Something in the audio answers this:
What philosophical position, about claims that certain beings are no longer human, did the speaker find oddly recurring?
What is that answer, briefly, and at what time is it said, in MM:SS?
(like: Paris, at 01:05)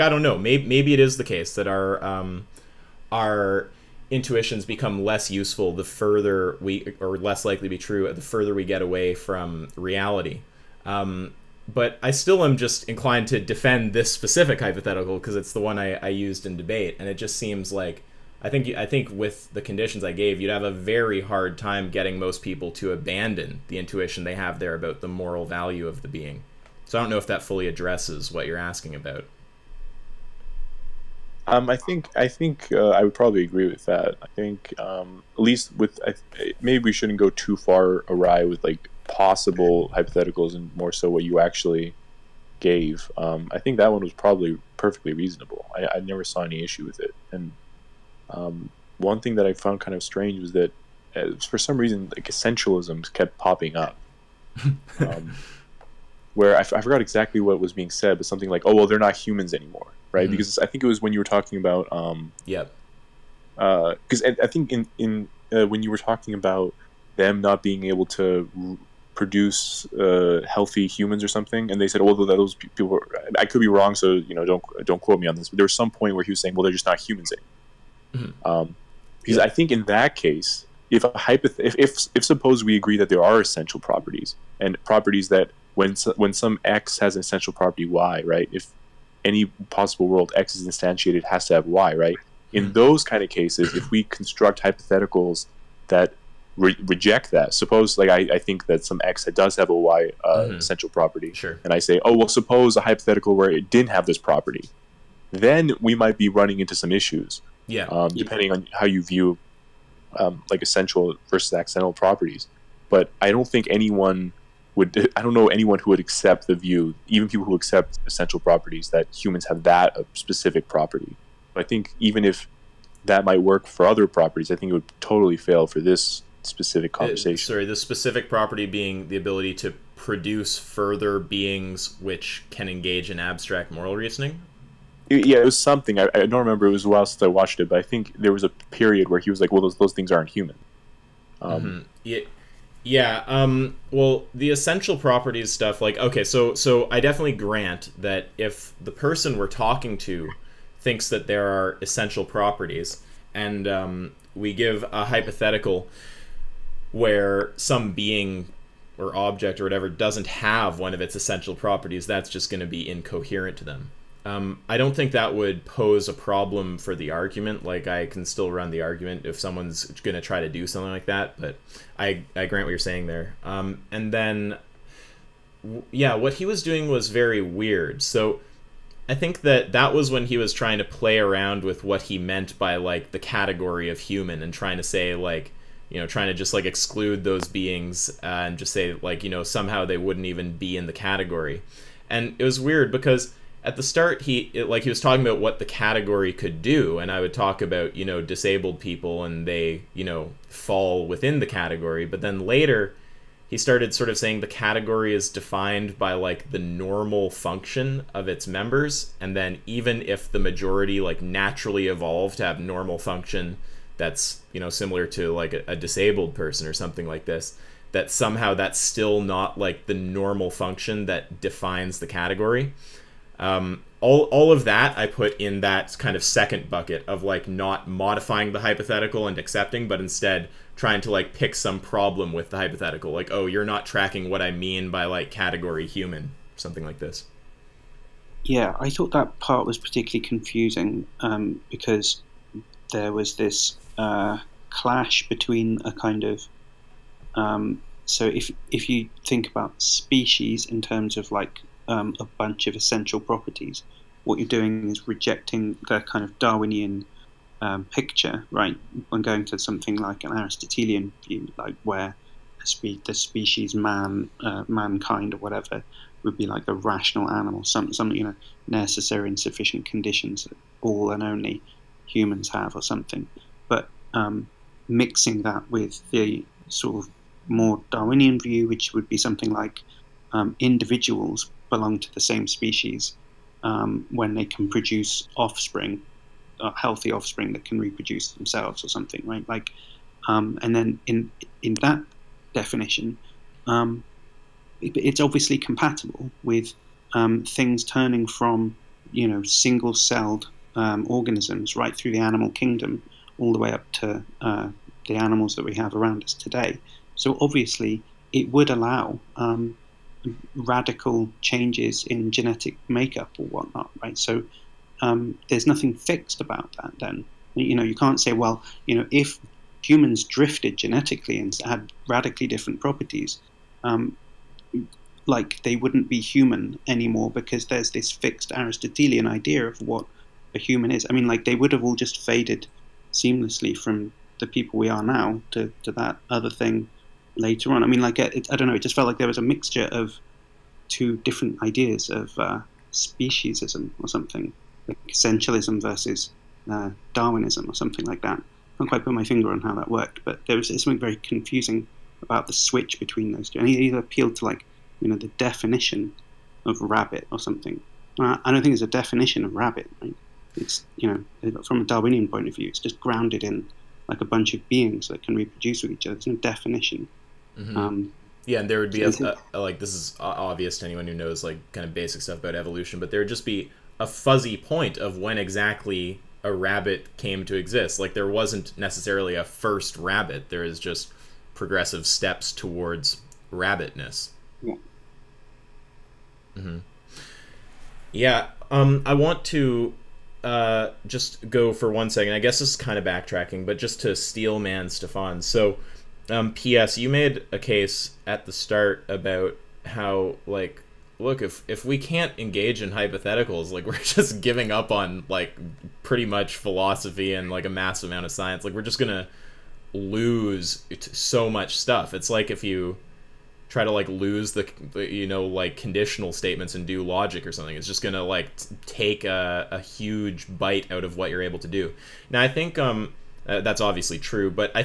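essentialisms, at 00:52.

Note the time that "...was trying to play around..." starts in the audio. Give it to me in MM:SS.
03:00.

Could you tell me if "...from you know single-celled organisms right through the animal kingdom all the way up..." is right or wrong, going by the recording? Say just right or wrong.
right.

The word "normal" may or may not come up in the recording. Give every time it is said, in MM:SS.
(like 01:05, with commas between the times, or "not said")
03:26, 03:32, 03:39.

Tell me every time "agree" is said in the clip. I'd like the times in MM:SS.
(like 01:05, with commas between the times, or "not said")
00:33, 01:22.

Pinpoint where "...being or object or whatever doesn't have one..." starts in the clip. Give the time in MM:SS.
02:37.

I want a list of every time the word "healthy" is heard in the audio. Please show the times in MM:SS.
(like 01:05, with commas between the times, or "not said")
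01:10, 04:46.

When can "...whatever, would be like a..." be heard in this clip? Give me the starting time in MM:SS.
04:25.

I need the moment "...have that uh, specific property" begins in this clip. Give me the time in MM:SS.
01:59.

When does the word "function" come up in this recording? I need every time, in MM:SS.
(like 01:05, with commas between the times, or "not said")
03:27, 03:32, 03:40.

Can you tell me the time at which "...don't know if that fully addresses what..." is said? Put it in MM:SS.
00:27.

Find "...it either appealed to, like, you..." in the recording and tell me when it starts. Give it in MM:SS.
05:53.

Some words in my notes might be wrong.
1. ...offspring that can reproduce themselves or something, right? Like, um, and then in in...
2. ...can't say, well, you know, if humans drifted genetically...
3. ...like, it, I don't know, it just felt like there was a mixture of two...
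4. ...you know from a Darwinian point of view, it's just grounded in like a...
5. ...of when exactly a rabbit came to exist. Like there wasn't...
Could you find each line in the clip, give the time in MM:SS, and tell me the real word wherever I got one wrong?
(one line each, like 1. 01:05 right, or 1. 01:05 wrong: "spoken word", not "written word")
1. 04:47 right
2. 05:17 right
3. 05:38 right
4. 06:00 right
5. 06:14 right.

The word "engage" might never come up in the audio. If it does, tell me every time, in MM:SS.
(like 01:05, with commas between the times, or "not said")
02:12, 06:42.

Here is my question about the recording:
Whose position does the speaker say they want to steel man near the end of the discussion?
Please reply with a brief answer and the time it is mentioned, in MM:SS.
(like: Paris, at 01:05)
Stefan, at 06:34.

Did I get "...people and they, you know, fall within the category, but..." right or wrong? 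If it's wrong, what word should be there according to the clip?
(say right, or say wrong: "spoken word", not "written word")
right.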